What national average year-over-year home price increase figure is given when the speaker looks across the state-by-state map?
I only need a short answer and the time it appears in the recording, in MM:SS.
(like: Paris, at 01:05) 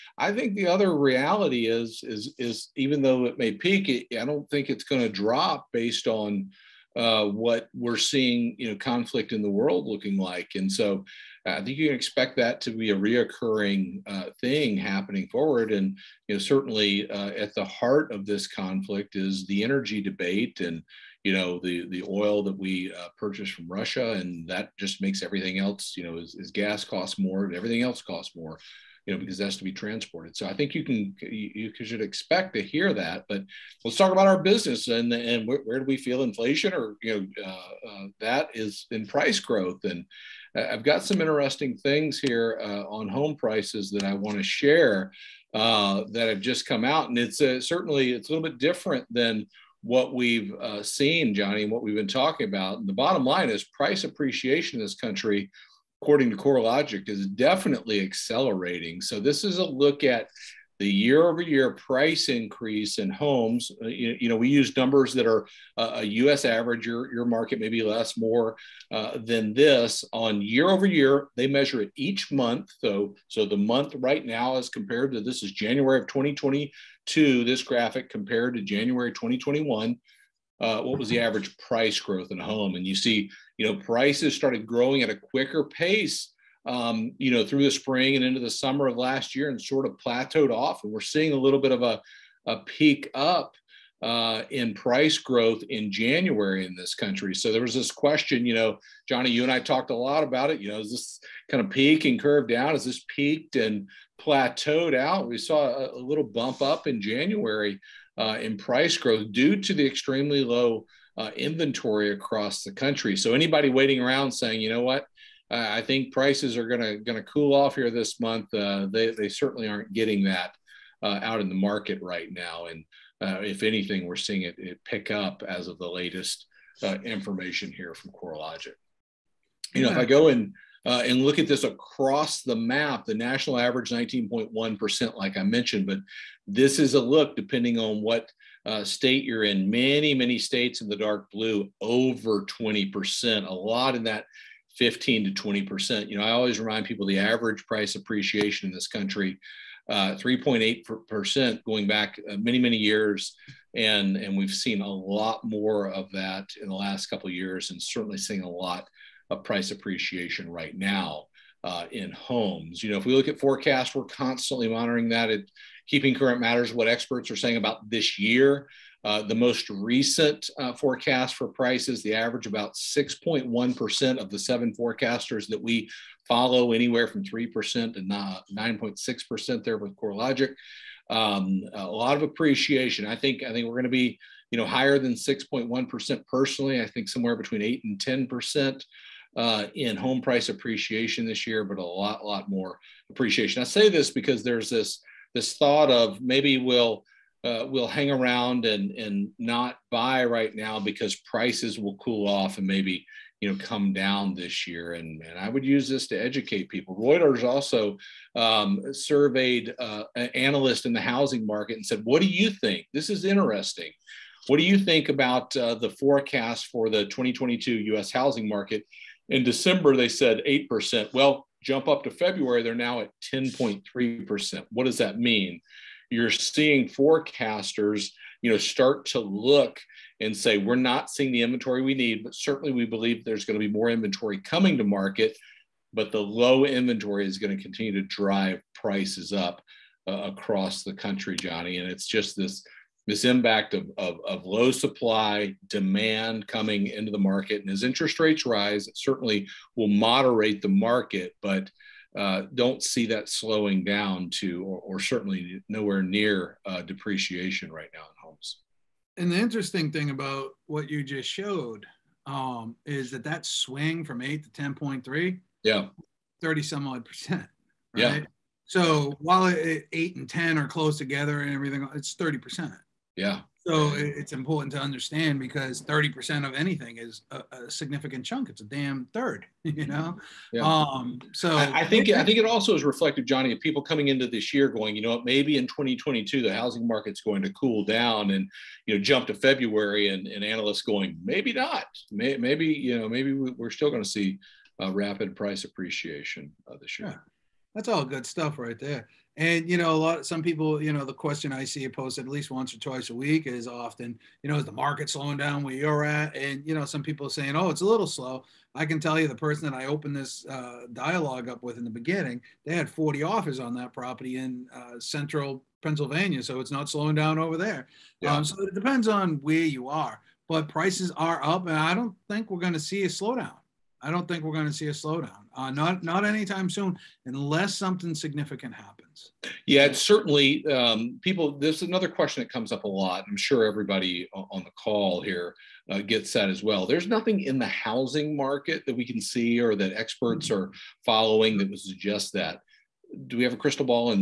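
19.1%, at 02:13.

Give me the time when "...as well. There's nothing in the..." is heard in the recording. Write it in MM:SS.
05:36.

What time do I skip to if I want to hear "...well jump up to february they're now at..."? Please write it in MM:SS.
03:41.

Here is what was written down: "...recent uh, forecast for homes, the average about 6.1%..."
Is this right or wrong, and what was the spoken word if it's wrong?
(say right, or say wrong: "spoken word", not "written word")
wrong: "prices", not "homes".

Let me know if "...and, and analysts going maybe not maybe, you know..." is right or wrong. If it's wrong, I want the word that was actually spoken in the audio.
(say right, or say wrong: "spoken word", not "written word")
right.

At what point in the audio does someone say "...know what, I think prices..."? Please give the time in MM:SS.
01:54.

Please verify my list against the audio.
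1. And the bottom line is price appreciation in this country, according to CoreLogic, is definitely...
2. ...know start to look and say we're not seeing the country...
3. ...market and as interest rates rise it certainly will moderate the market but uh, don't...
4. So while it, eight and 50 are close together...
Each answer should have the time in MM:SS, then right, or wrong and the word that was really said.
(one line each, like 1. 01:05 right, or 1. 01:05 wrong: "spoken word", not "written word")
1. 00:52 right
2. 03:48 wrong: "inventory", not "country"
3. 04:07 right
4. 04:28 wrong: "10", not "50".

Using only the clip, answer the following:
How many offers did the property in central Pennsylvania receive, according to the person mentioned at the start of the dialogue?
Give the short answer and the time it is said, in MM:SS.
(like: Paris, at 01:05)
40, at 05:12.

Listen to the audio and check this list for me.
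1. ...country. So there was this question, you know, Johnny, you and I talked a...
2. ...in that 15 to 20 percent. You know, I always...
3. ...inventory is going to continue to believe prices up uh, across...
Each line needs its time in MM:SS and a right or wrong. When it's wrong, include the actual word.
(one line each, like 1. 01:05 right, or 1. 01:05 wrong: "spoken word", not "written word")
1. 01:36 right
2. 02:23 right
3. 03:56 wrong: "drive", not "believe".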